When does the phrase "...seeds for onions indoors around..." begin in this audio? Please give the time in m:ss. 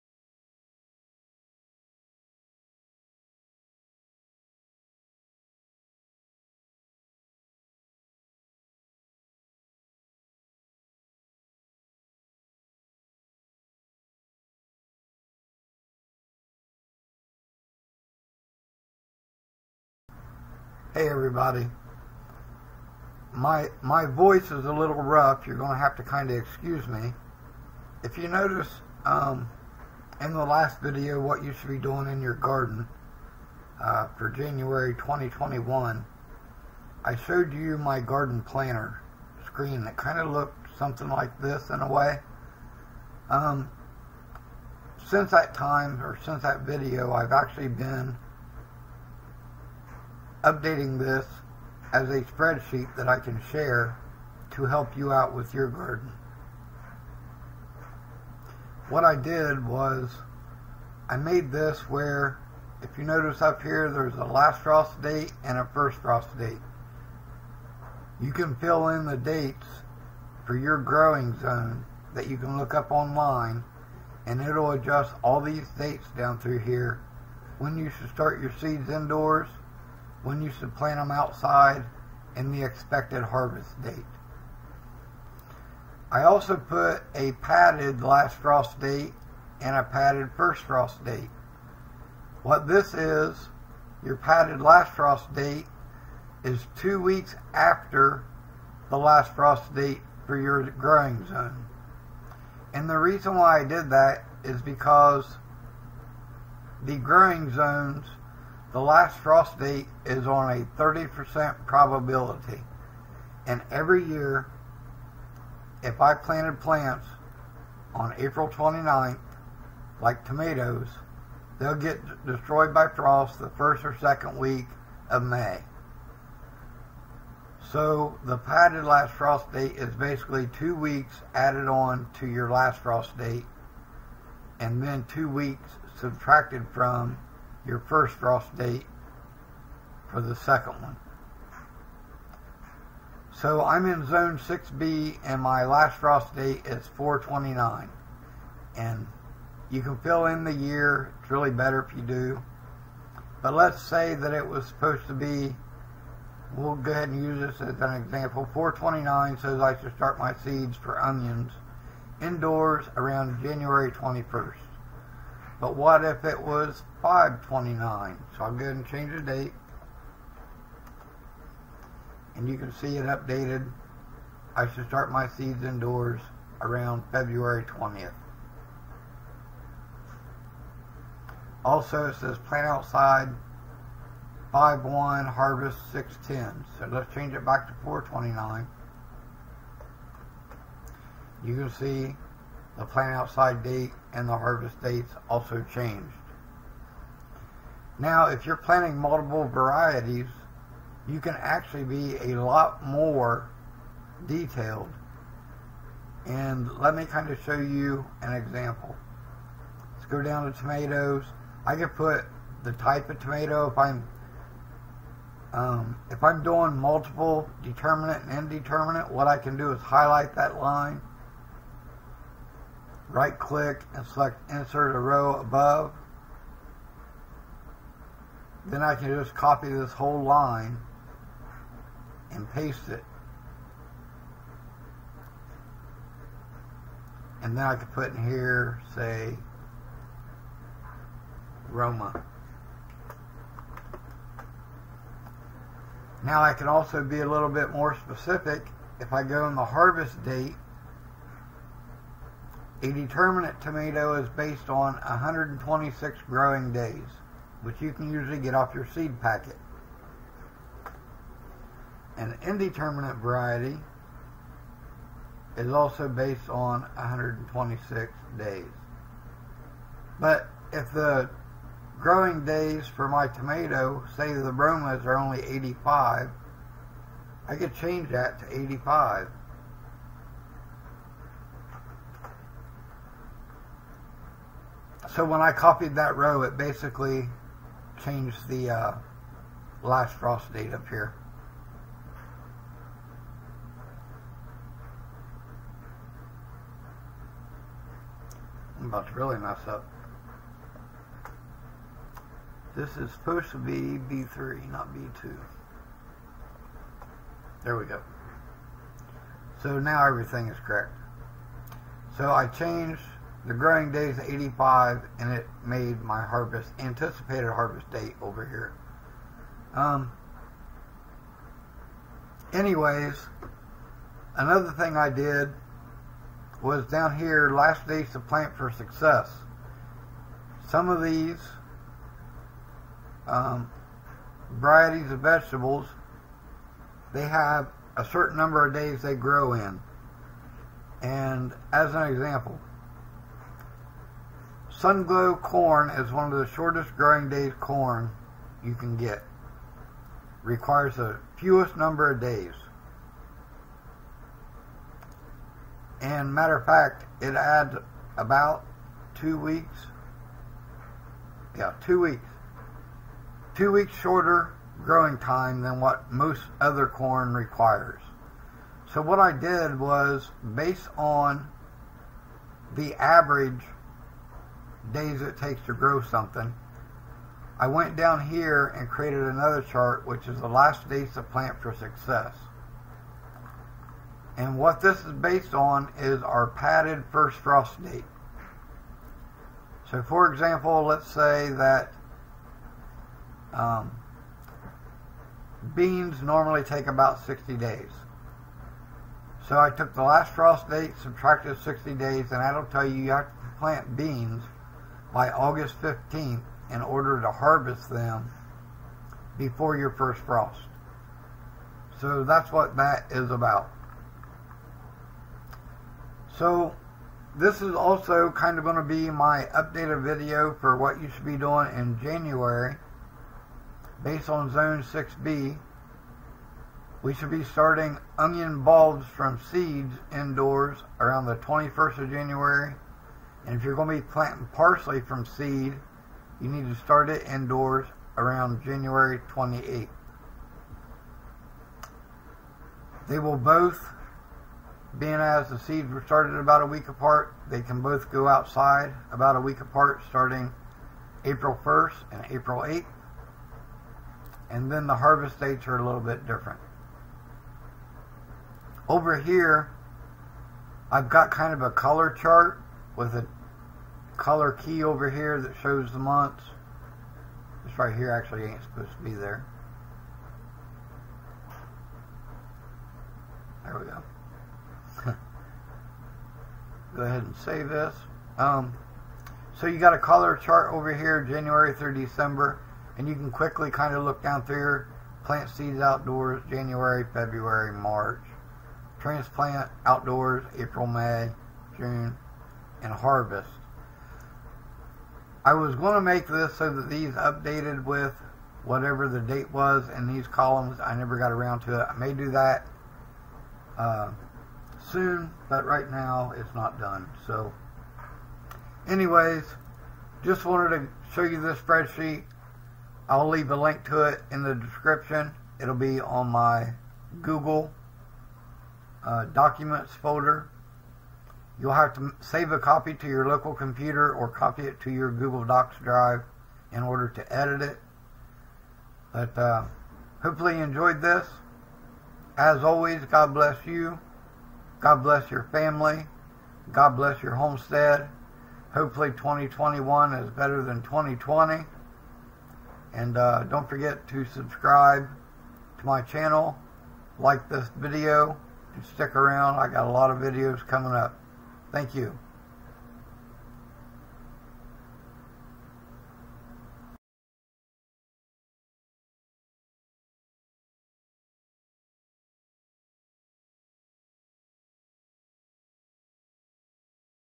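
2:40.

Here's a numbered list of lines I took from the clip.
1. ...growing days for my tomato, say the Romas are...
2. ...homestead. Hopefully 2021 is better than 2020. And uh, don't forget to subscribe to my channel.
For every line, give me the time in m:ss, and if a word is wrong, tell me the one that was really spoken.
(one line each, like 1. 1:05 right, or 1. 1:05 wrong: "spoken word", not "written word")
1. 4:31 right
2. 8:57 right.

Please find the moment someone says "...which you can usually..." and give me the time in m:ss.
4:17.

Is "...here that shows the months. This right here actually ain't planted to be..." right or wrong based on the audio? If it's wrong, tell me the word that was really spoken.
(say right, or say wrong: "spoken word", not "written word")
wrong: "supposed", not "planted".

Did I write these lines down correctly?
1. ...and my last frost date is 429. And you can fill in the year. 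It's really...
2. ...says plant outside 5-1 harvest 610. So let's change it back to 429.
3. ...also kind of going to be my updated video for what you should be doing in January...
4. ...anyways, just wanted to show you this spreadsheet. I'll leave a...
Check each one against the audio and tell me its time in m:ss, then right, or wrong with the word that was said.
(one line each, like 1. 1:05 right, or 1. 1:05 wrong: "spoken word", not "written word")
1. 2:25 right
2. 3:02 right
3. 6:57 right
4. 8:28 right.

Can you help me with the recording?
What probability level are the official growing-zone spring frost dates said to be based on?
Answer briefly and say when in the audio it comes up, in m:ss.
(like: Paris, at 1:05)
30%, at 1:50.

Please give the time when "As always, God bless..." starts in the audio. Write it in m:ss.
8:52.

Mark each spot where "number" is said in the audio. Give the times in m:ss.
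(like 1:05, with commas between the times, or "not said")
5:38, 5:51.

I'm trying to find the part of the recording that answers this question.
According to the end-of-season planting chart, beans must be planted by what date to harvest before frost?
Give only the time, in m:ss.
6:45.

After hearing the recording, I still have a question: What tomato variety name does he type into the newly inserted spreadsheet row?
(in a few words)
Roma.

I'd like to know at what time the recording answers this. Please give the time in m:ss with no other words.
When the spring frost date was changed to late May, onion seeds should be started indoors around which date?
2:57.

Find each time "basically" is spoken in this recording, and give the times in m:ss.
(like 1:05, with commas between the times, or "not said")
2:09, 4:46.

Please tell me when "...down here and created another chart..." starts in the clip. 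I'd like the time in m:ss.
6:17.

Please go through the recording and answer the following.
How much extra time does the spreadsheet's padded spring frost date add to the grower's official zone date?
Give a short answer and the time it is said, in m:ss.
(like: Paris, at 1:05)
2 weeks, at 1:36.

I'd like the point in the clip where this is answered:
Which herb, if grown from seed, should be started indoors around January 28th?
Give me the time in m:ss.
7:14.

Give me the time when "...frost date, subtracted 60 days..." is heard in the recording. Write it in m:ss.
6:40.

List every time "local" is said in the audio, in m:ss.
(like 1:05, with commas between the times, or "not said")
8:43.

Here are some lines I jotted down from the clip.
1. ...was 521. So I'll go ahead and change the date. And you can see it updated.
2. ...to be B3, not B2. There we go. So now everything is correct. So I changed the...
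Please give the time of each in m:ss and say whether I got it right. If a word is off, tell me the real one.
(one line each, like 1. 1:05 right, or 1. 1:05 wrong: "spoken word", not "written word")
1. 2:46 wrong: "529", not "521"
2. 5:03 right.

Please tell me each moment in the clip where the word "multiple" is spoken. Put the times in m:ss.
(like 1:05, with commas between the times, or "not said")
3:18, 3:36.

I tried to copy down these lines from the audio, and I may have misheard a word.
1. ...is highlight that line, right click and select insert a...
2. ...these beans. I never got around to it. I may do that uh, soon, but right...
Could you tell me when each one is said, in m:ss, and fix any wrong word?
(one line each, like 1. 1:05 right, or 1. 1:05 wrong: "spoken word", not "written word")
1. 3:39 right
2. 8:20 wrong: "columns", not "beans".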